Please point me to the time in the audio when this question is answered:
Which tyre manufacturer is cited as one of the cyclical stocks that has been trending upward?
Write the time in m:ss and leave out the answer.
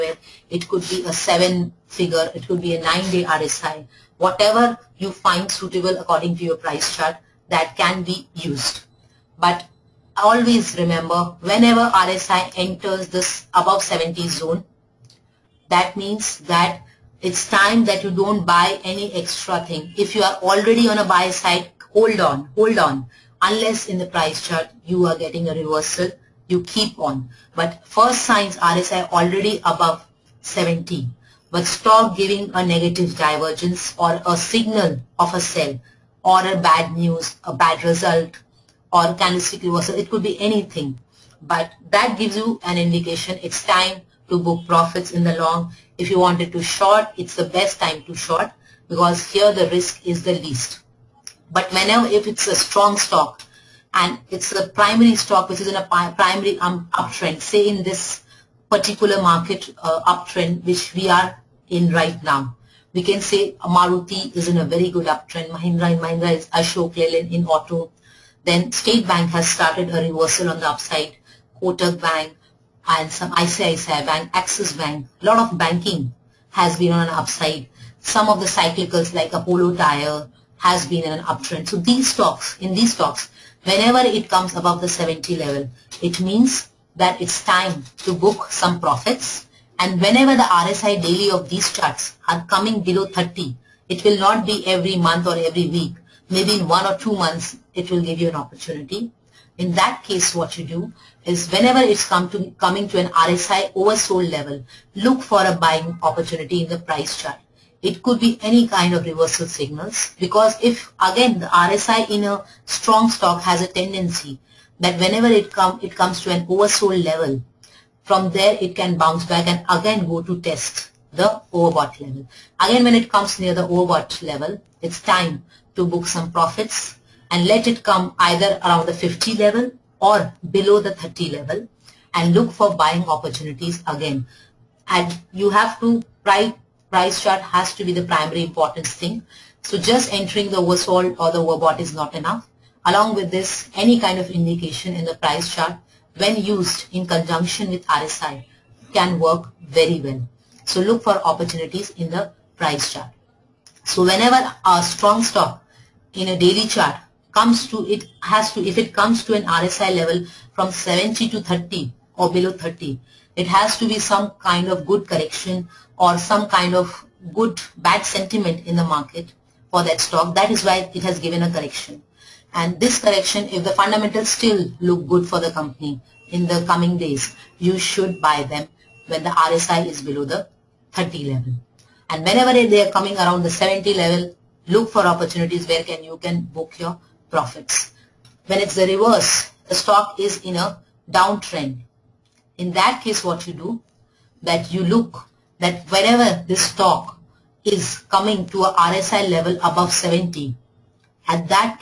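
1:19.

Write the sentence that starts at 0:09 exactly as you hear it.
But always remember whenever RSI enters this above 70 zone, that means that it's time that you don't buy any extra thing.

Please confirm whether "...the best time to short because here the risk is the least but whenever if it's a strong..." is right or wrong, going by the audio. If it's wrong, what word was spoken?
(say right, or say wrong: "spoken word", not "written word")
right.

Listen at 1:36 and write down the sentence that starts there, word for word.
Maybe in one or two months, it will give you an opportunity.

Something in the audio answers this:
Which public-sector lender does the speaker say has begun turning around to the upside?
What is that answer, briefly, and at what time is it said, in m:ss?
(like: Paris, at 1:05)
State Bank, at 1:08.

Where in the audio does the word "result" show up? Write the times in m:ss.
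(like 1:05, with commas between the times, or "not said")
0:37.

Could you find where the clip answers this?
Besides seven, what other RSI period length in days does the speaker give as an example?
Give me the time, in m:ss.
0:02.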